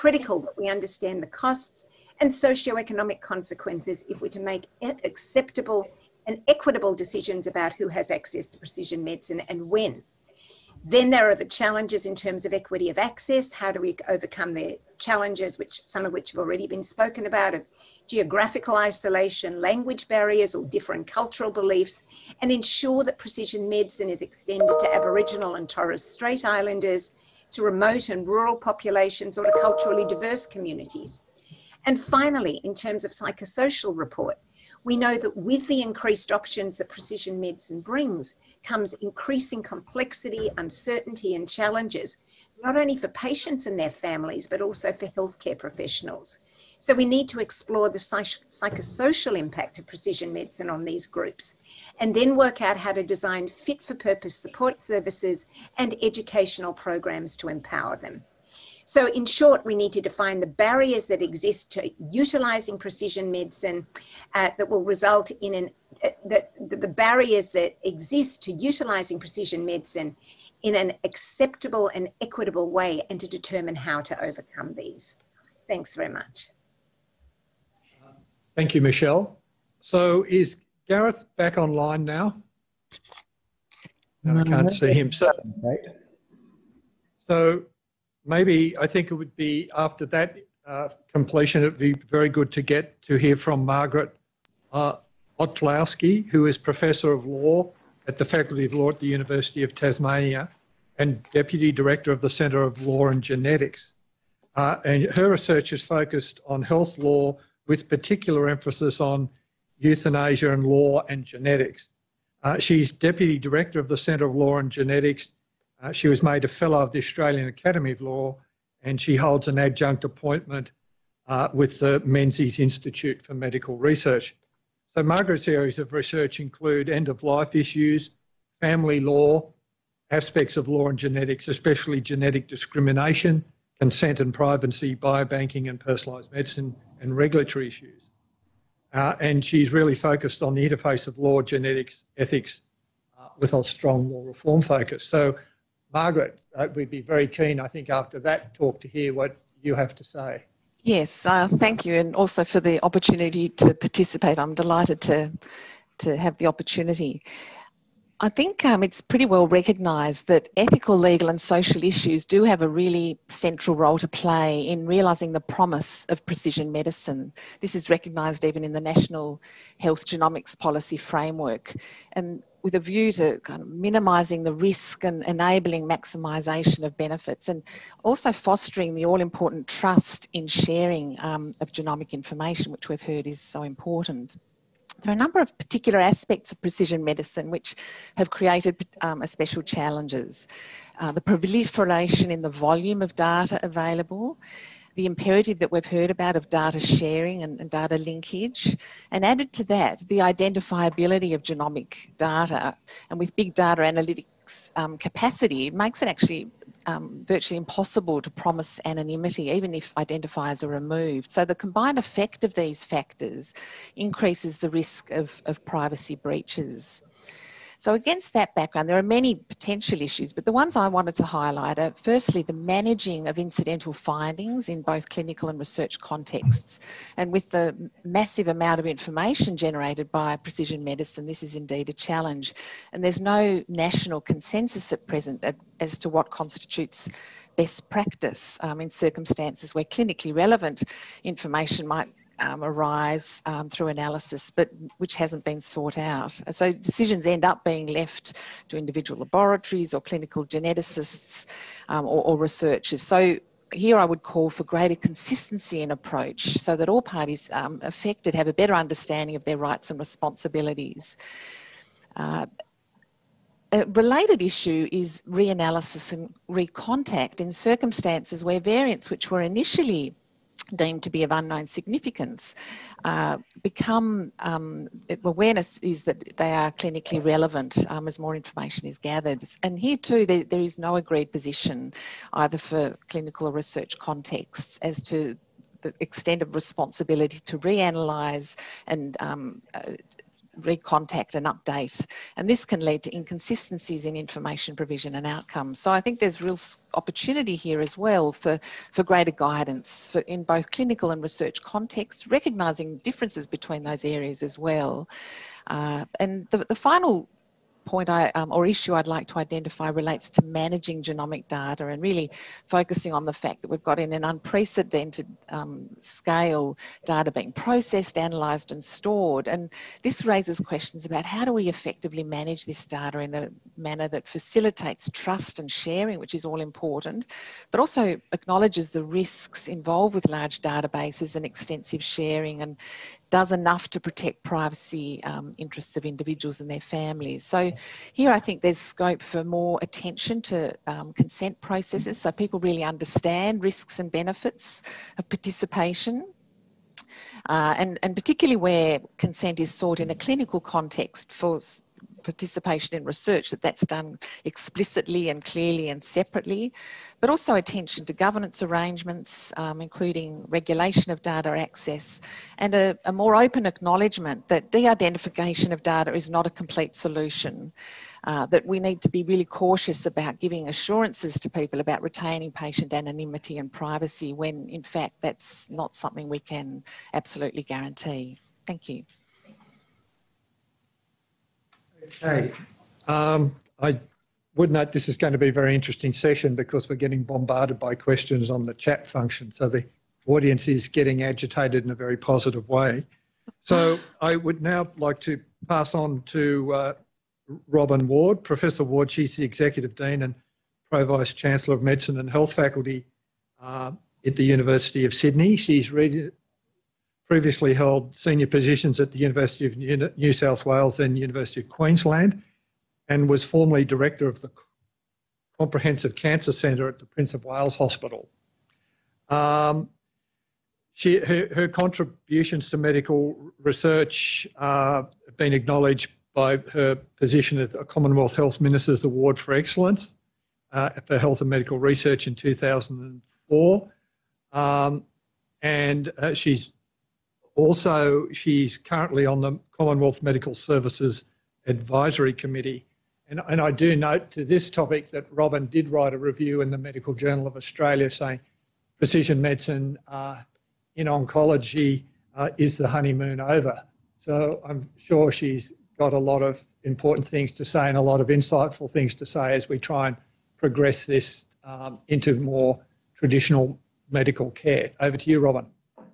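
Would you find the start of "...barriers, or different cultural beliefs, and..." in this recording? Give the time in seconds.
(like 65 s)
20 s.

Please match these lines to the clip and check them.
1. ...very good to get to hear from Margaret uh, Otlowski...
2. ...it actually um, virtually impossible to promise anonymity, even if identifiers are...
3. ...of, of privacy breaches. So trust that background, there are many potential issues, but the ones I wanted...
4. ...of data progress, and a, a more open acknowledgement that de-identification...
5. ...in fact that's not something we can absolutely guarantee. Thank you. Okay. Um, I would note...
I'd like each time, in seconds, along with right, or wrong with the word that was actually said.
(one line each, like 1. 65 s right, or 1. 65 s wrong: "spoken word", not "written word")
1. 91 s right
2. 206 s right
3. 215 s wrong: "against", not "trust"
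4. 361 s wrong: "access", not "progress"
5. 374 s right.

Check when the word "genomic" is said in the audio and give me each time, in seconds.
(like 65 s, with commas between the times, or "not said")
170 s, 181 s, 201 s, 311 s.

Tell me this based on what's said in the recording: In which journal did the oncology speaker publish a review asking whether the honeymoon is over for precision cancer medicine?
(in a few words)
Medical Journal of Australia.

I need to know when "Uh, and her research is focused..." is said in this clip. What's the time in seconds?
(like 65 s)
104 s.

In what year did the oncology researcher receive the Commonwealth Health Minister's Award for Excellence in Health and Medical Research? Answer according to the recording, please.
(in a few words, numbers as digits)
2004.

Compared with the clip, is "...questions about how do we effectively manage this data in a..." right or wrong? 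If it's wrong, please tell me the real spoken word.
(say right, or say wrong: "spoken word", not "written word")
right.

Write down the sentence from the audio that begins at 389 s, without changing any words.
So the audience is getting agitated in a very positive way.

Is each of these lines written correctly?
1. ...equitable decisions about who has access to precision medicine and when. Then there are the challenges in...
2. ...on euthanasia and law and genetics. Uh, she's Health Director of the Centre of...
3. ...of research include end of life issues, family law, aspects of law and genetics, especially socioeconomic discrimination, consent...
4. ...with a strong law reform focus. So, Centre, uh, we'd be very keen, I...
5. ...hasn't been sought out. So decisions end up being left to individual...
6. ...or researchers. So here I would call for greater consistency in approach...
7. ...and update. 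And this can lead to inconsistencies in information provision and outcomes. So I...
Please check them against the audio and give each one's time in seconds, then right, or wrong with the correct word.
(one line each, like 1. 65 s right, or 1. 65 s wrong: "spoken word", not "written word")
1. 6 s right
2. 109 s wrong: "Deputy", not "Health"
3. 125 s wrong: "genetic", not "socioeconomic"
4. 143 s wrong: "Margaret", not "Centre"
5. 245 s right
6. 252 s right
7. 291 s right.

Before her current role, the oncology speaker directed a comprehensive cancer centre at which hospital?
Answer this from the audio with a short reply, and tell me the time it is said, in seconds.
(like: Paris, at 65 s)
Prince of Wales Hospital, at 417 s.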